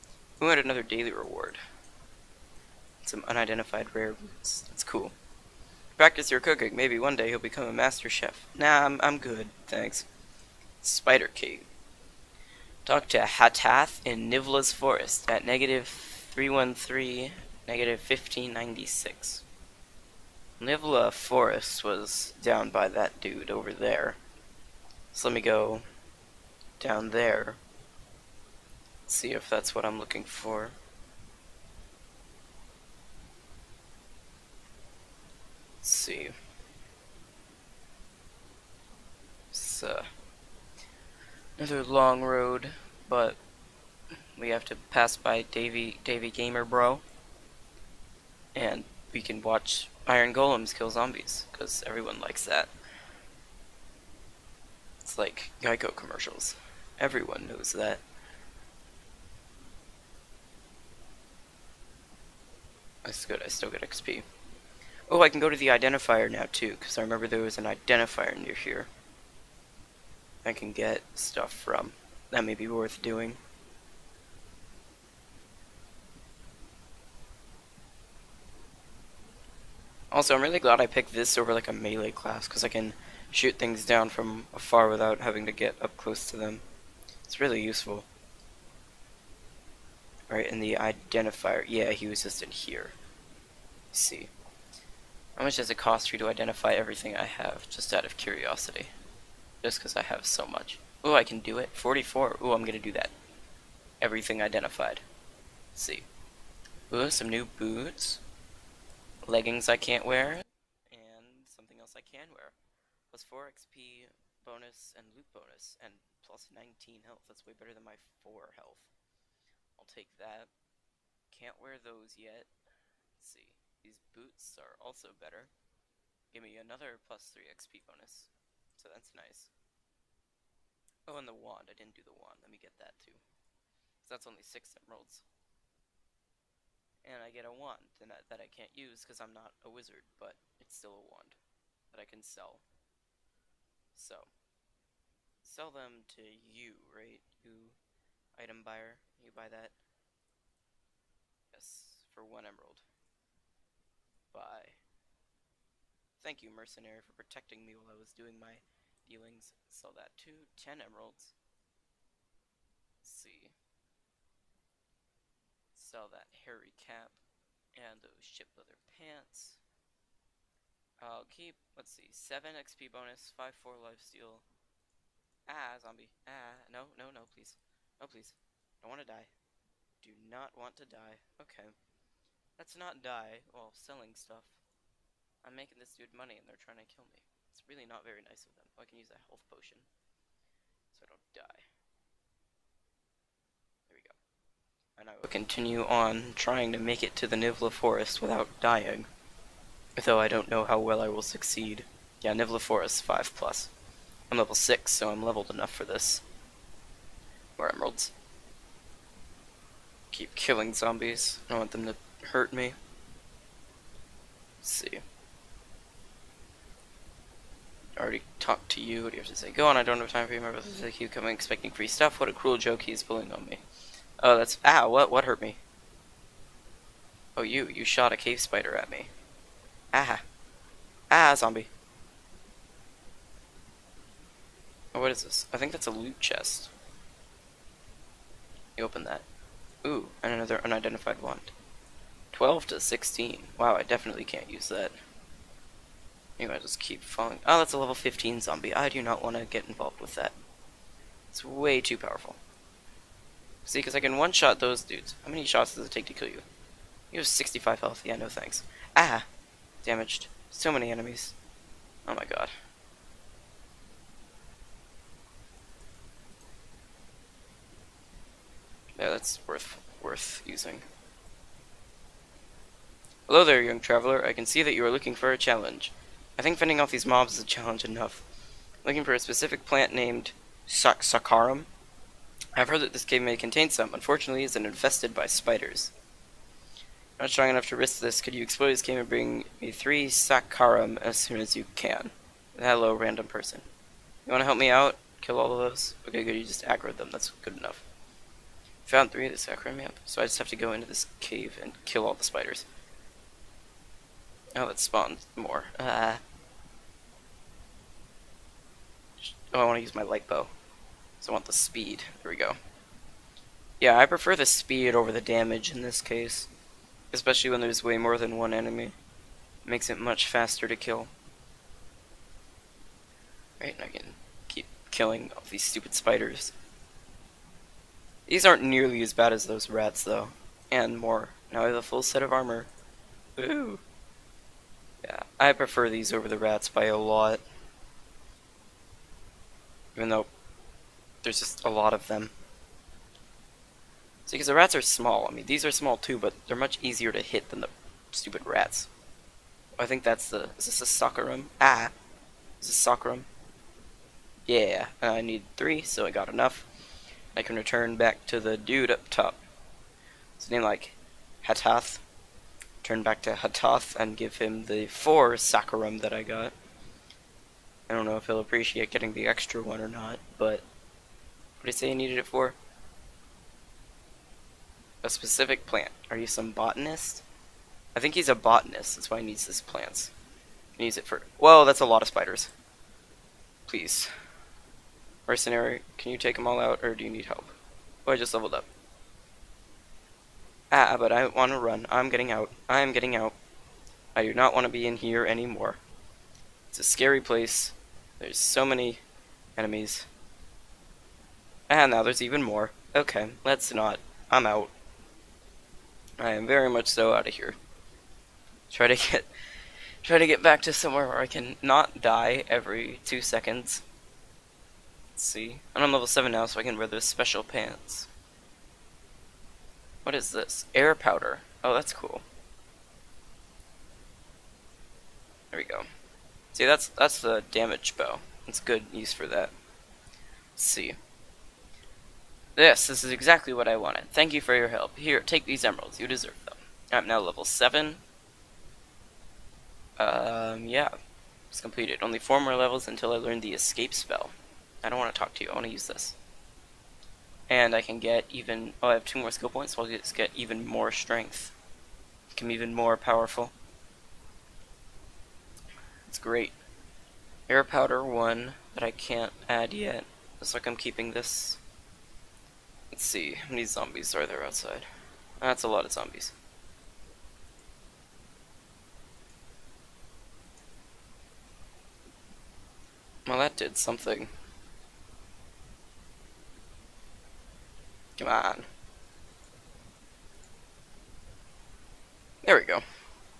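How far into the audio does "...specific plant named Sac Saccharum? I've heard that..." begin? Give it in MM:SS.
04:39.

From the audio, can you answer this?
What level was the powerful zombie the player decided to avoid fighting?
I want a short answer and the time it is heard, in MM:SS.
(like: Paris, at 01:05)
15, at 04:07.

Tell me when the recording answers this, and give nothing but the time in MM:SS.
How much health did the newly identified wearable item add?
01:56.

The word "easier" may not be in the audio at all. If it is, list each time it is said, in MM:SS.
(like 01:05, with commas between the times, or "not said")
05:46.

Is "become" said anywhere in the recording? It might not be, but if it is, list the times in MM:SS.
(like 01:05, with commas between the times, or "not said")
00:07, 07:32.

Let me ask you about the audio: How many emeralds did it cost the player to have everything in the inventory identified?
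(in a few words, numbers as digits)
44.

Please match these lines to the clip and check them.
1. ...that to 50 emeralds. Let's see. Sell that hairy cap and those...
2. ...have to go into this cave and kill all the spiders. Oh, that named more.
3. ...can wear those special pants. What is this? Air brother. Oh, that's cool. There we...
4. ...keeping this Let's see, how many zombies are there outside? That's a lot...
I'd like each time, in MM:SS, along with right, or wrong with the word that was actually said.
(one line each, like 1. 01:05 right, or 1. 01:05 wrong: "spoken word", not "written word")
1. 02:39 wrong: "10", not "50"
2. 05:00 wrong: "spawned", not "named"
3. 06:56 wrong: "powder", not "brother"
4. 07:40 right.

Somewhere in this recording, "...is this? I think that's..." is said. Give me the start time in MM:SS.
03:55.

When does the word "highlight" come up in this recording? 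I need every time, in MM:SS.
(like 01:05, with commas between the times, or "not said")
not said.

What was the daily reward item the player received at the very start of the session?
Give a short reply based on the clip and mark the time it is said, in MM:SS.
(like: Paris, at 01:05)
Unidentified rare roots, at 00:03.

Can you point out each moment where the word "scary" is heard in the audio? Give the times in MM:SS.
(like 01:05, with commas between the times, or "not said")
06:36.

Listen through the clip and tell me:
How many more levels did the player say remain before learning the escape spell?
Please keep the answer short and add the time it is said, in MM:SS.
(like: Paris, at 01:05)
4, at 07:22.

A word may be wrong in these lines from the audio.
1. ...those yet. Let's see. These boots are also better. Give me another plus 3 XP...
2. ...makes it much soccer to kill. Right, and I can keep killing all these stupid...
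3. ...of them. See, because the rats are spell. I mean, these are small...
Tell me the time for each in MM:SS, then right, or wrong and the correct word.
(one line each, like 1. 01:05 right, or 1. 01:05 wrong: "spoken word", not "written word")
1. 02:01 right
2. 05:19 wrong: "faster", not "soccer"
3. 05:41 wrong: "small", not "spell".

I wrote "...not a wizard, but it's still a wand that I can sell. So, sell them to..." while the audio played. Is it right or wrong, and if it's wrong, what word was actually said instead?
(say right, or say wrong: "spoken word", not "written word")
right.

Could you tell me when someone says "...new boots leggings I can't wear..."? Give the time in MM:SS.
01:47.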